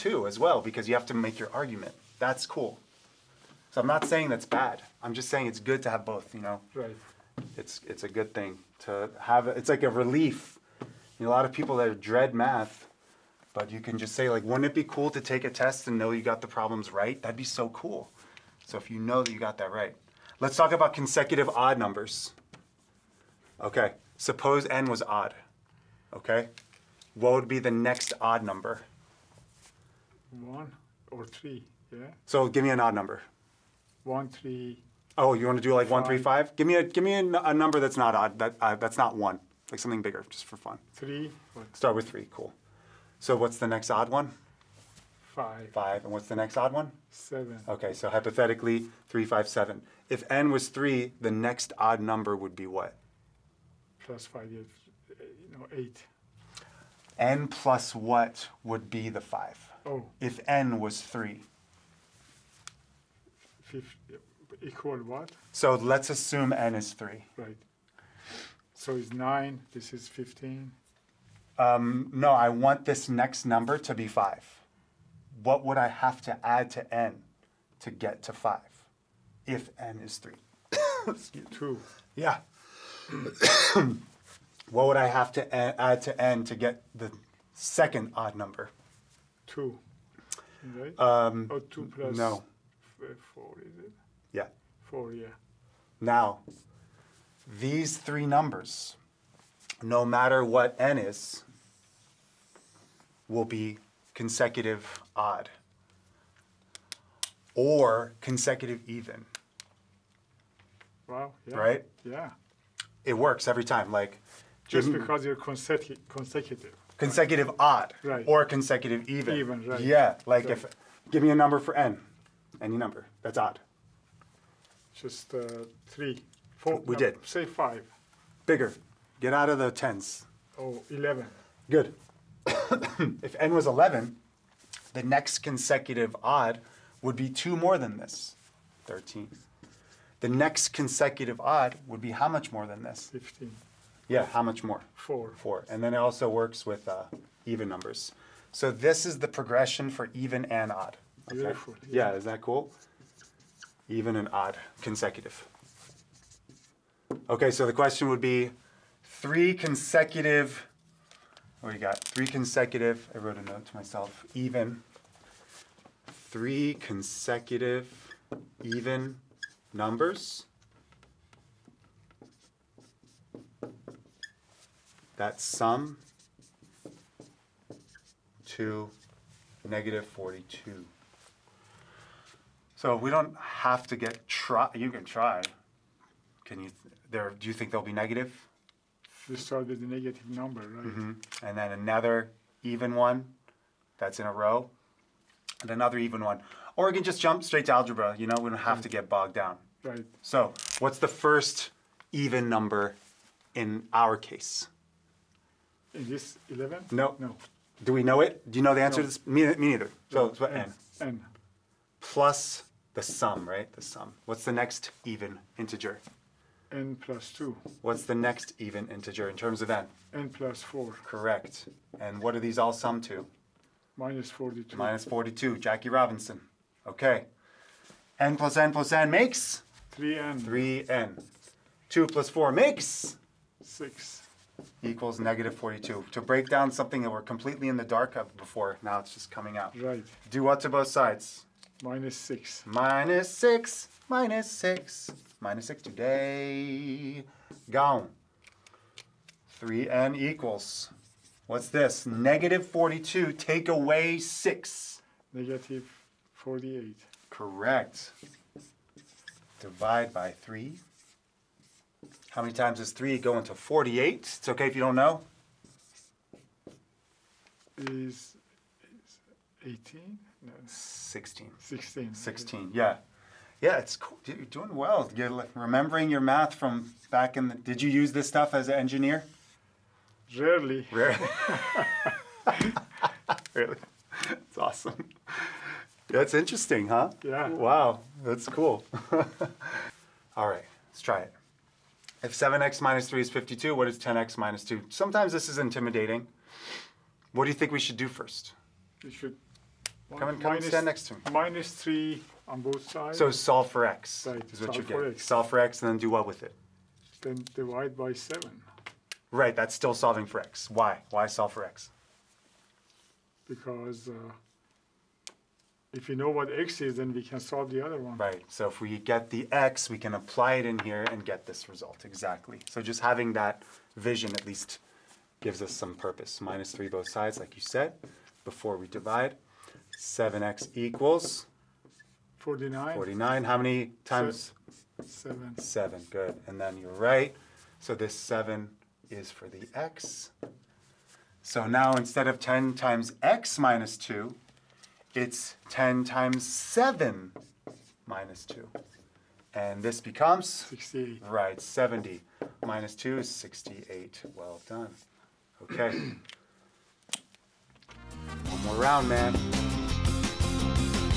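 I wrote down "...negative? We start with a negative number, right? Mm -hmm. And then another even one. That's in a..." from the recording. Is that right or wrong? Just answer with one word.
right.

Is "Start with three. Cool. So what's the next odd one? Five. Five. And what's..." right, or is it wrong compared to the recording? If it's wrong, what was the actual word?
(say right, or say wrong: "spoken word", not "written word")
right.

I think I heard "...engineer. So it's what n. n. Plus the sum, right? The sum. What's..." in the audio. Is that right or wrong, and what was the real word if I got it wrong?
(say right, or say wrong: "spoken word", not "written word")
wrong: "neither", not "engineer".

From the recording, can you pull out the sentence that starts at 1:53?
Like just mm because you're consecu consecutive.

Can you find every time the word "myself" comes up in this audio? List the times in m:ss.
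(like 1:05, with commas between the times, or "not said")
2:43.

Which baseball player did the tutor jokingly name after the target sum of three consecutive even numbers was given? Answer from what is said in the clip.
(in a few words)
Jackie Robinson.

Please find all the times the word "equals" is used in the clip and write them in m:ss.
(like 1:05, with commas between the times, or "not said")
1:04, 3:54, 4:10, 5:30.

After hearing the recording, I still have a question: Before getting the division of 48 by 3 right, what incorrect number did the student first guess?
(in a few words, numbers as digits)
18.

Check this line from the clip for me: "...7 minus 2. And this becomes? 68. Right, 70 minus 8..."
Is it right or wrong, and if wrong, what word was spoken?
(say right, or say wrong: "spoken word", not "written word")
wrong: "2", not "8".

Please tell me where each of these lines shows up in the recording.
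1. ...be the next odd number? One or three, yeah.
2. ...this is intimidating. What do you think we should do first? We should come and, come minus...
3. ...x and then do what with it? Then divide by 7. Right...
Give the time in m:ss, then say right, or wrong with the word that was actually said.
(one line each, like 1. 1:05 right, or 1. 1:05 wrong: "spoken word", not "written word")
1. 0:27 right
2. 4:55 right
3. 5:05 right.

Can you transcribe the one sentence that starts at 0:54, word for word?
Plus five, uh, you know, eight n plus what would be the 5?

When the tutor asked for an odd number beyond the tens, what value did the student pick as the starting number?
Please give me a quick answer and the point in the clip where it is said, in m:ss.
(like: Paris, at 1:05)
11, at 2:10.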